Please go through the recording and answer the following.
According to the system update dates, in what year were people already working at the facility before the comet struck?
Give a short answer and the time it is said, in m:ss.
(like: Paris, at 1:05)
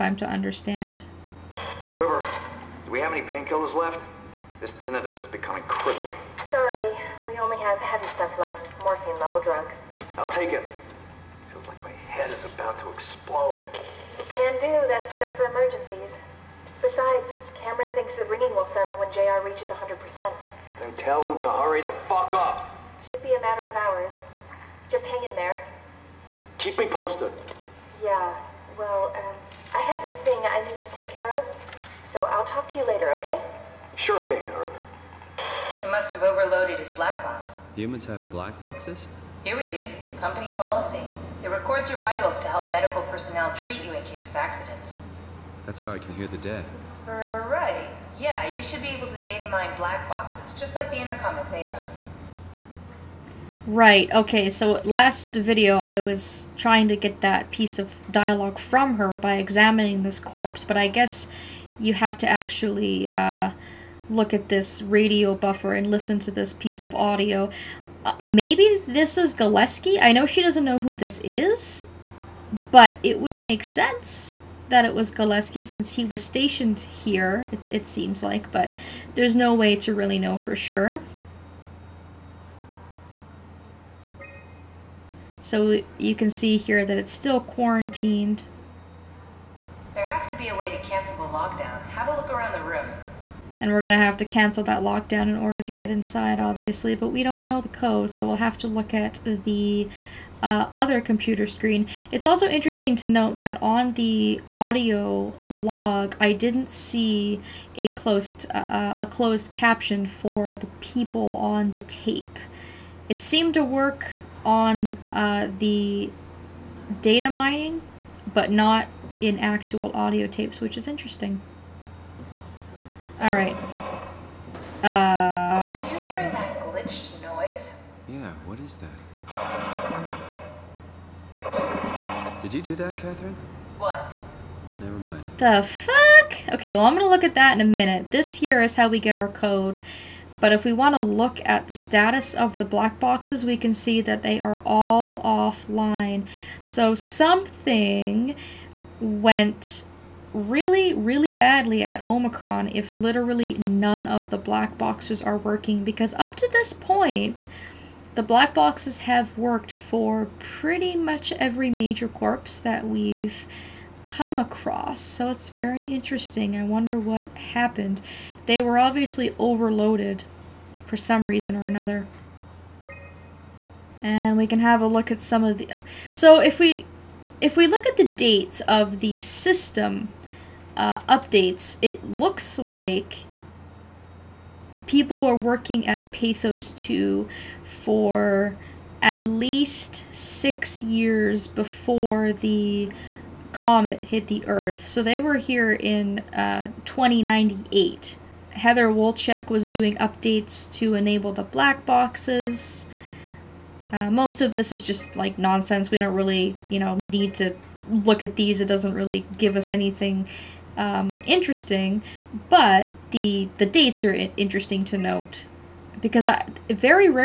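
2098, at 3:16.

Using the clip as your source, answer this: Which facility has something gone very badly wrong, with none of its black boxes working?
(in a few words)
Omicron.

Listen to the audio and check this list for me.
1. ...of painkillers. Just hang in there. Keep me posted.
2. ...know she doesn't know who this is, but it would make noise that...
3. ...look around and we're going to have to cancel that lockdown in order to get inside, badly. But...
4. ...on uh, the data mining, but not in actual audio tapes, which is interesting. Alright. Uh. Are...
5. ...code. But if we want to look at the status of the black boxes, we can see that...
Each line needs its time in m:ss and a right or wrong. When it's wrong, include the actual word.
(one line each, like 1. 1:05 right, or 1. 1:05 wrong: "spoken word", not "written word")
1. 0:23 wrong: "hours", not "painkillers"
2. 1:10 wrong: "sense", not "noise"
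3. 1:32 wrong: "obviously", not "badly"
4. 1:54 right
5. 2:19 right.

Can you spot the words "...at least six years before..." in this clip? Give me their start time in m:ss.
3:09.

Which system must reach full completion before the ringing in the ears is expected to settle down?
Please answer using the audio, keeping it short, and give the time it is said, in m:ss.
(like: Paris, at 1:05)
JR, at 0:19.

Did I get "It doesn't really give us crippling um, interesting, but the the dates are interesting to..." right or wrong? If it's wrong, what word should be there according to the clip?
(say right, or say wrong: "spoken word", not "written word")
wrong: "anything", not "crippling".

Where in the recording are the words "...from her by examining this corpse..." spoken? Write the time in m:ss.
0:58.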